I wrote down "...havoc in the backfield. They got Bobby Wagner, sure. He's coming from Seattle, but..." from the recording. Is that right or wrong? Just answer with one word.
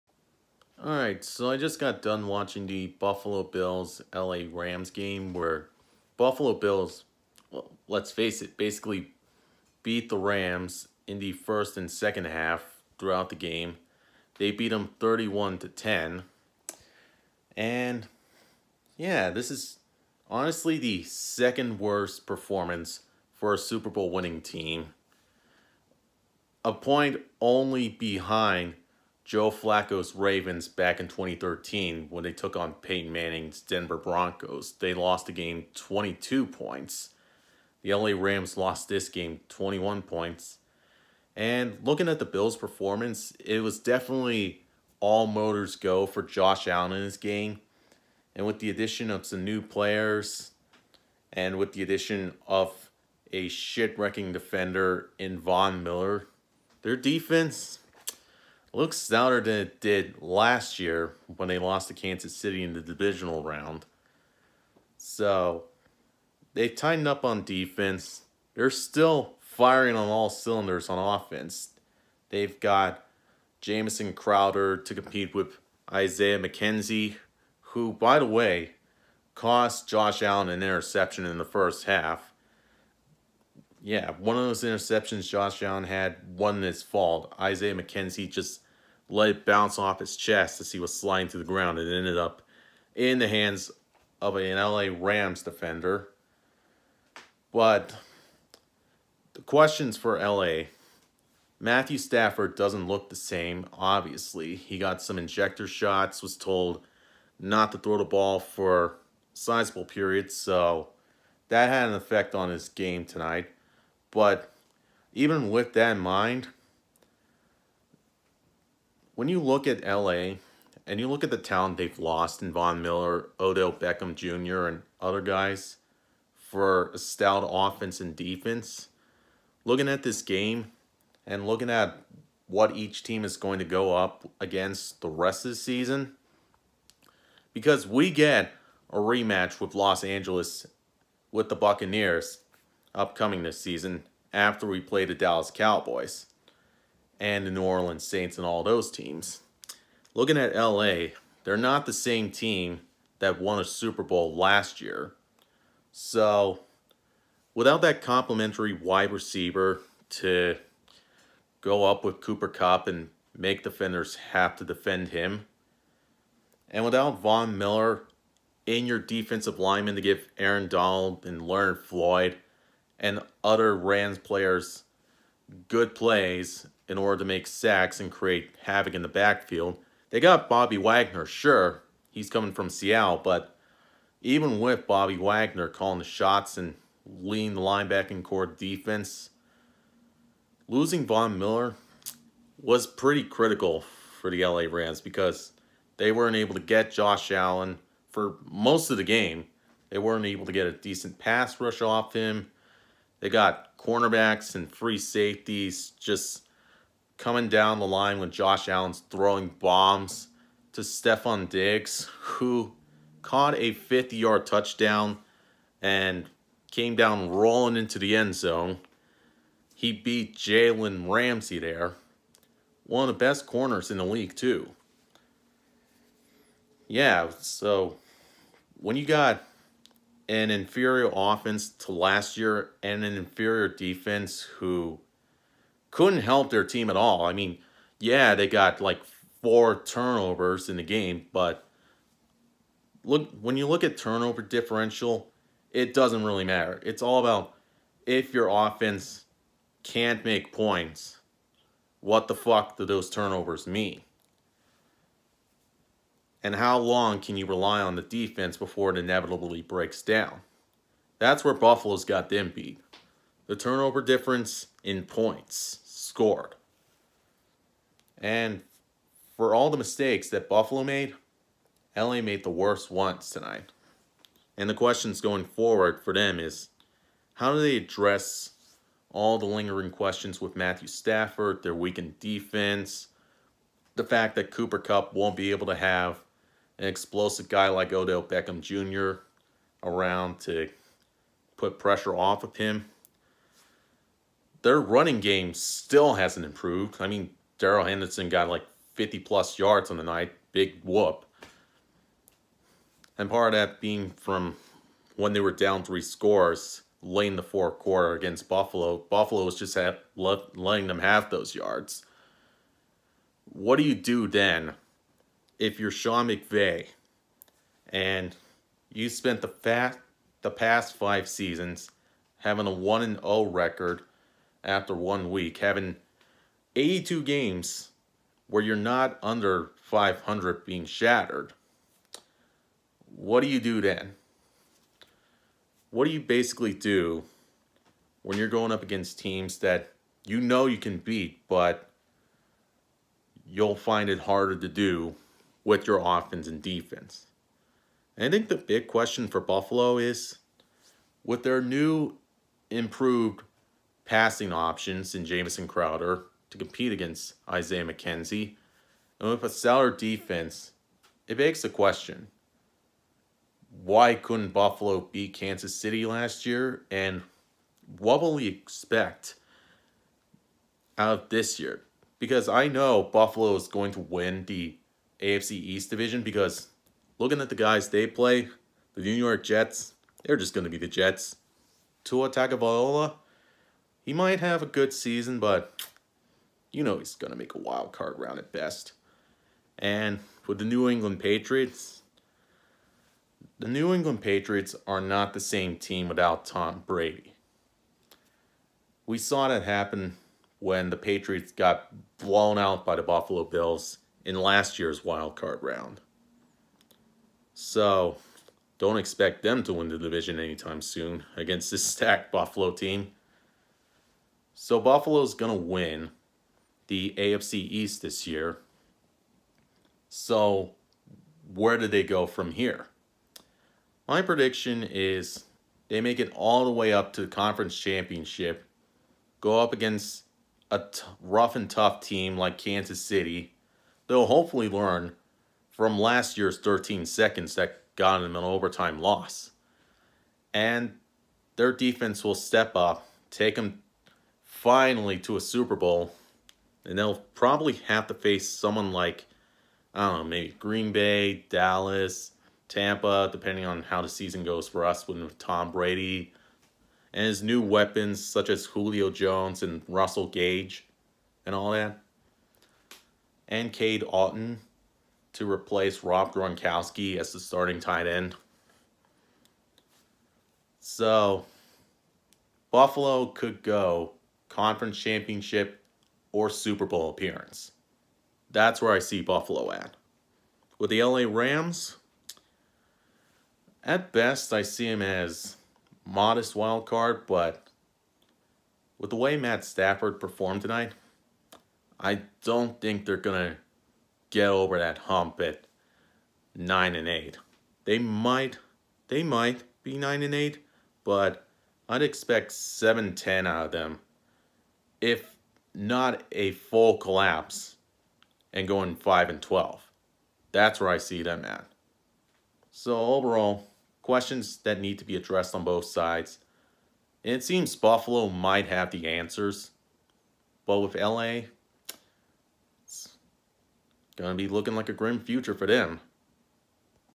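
right.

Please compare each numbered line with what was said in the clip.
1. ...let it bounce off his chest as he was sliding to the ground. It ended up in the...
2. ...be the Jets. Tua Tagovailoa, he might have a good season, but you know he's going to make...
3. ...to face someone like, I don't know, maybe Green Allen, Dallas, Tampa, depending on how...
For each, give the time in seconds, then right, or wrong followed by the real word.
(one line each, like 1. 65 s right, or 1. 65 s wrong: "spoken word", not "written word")
1. 89 s right
2. 380 s right
3. 448 s wrong: "Bay", not "Allen".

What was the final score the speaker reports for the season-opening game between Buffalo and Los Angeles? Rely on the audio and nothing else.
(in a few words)
31 to 10.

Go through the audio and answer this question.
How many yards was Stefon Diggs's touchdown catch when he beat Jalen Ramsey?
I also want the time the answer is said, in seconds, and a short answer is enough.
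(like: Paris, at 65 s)
50-yard, at 213 s.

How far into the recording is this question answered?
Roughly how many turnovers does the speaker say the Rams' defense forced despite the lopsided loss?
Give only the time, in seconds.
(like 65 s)
239 s.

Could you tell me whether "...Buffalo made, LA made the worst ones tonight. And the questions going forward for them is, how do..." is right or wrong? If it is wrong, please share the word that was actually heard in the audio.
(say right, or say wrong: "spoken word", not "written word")
right.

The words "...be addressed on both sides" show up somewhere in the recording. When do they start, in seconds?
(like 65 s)
515 s.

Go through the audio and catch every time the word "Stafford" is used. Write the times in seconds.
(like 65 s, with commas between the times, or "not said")
101 s, 280 s, 489 s.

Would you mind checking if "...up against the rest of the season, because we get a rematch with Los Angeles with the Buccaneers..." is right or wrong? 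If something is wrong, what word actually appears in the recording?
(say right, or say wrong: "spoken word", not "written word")
right.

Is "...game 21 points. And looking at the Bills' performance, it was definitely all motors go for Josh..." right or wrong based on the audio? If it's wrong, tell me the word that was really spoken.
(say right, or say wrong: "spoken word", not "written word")
right.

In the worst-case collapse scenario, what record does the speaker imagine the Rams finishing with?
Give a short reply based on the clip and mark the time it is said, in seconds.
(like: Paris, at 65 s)
5 and 12, at 508 s.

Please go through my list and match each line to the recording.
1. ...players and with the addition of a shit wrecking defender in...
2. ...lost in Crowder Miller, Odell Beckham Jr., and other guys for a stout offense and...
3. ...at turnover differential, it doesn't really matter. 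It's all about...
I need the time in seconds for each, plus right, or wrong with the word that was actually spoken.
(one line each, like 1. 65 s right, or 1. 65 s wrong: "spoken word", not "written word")
1. 49 s right
2. 121 s wrong: "Von", not "Crowder"
3. 243 s right.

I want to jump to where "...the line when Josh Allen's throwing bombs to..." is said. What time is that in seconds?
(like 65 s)
207 s.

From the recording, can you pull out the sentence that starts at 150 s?
Looking at LA, they're not the same team that won a Super Bowl last year.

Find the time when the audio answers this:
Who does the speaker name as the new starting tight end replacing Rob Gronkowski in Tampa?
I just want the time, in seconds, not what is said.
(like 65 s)
463 s.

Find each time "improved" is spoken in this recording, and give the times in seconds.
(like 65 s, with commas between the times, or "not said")
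296 s, 352 s.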